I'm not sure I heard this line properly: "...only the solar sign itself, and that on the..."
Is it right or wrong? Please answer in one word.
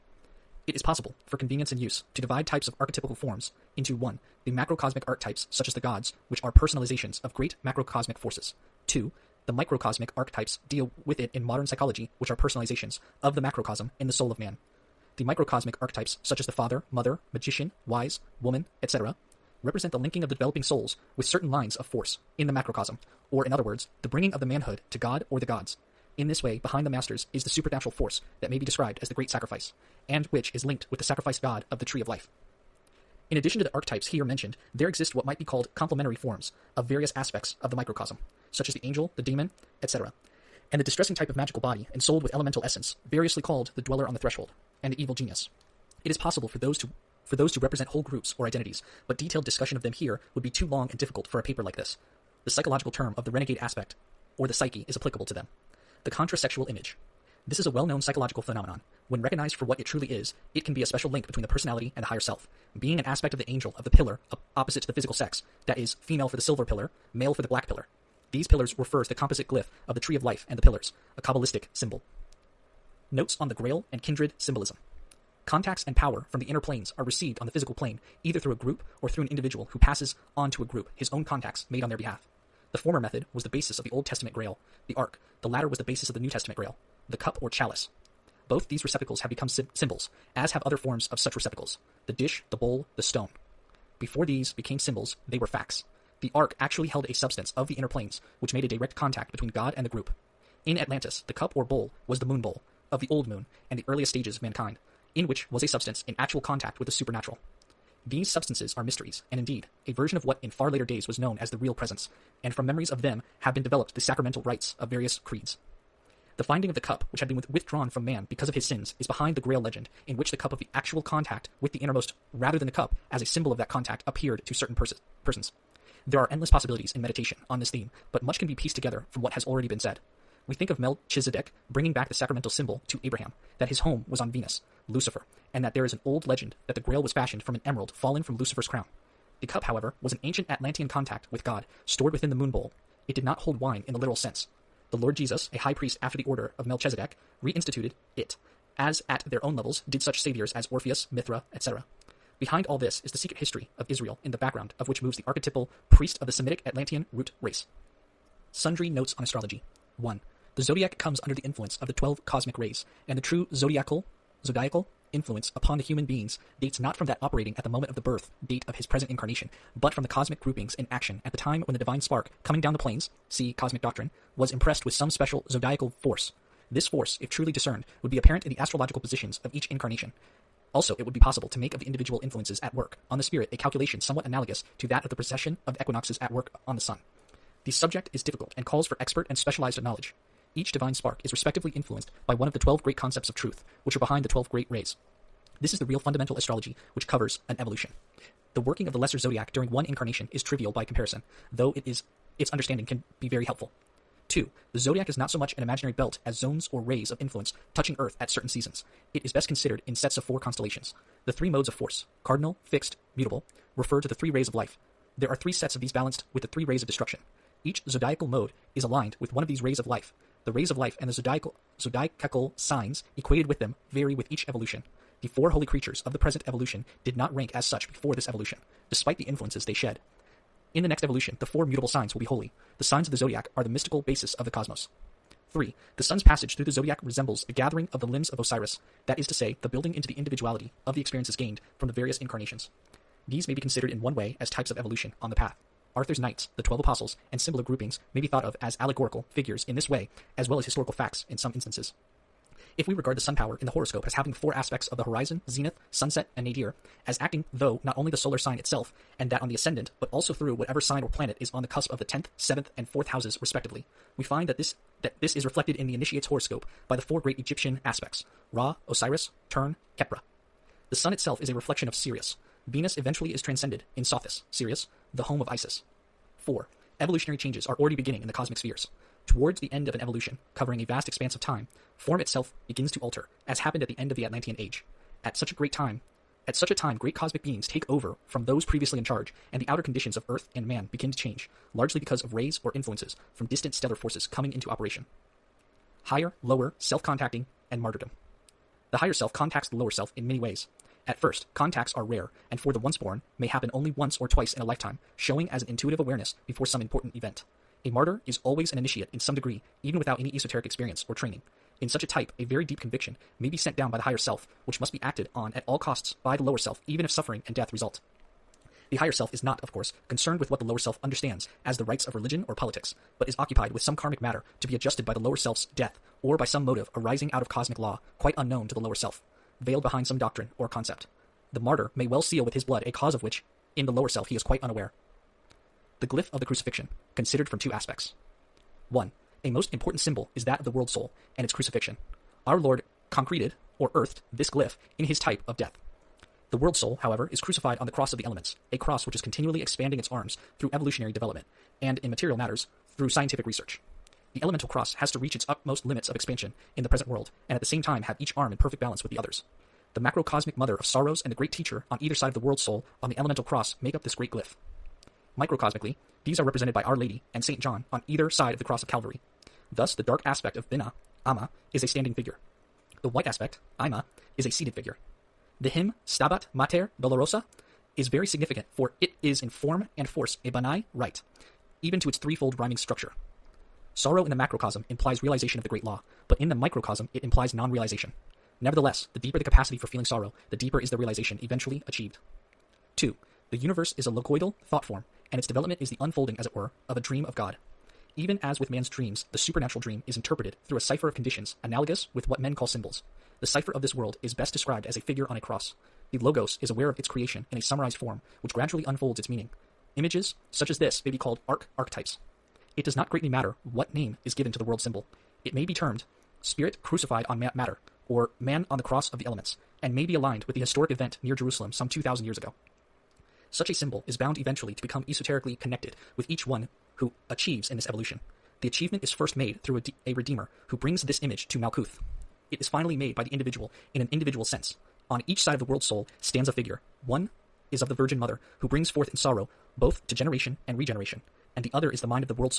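right.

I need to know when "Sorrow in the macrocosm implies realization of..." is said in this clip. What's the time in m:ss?
6:23.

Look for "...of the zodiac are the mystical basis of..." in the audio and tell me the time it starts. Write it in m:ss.
3:53.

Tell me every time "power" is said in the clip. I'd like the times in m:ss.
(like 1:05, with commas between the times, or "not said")
1:15, 4:13.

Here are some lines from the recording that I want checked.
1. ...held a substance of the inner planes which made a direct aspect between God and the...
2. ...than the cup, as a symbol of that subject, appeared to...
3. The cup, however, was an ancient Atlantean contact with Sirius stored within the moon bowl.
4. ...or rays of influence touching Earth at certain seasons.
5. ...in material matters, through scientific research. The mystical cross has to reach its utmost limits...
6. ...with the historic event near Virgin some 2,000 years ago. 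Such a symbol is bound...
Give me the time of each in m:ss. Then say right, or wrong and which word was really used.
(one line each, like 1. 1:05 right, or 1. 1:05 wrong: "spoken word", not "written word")
1. 1:36 wrong: "contact", not "aspect"
2. 2:02 wrong: "contact", not "subject"
3. 2:19 wrong: "God", not "Sirius"
4. 3:26 right
5. 5:52 wrong: "elemental", not "mystical"
6. 7:00 wrong: "Jerusalem", not "Virgin".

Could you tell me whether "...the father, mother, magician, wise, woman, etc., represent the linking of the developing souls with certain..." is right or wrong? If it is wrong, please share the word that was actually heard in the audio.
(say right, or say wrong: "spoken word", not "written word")
right.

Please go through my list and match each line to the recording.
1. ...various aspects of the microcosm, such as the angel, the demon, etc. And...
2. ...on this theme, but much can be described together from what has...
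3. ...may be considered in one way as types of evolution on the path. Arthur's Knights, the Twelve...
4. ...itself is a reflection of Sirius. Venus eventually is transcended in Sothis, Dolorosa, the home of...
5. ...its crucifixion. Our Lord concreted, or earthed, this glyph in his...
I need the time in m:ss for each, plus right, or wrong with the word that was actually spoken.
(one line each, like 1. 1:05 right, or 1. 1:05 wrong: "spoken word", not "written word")
1. 0:36 right
2. 2:07 wrong: "pieced", not "described"
3. 4:03 right
4. 4:31 wrong: "Sirius", not "Dolorosa"
5. 5:41 right.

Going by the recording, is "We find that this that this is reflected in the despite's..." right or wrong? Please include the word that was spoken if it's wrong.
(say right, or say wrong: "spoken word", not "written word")
wrong: "initiate", not "despite".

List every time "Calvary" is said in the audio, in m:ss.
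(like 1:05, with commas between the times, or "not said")
6:08.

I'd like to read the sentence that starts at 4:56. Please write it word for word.
Higher, lower, self contacting, and martyrdom.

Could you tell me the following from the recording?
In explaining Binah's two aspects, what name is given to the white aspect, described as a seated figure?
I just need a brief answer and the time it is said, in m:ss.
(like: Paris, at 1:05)
Ima, at 6:13.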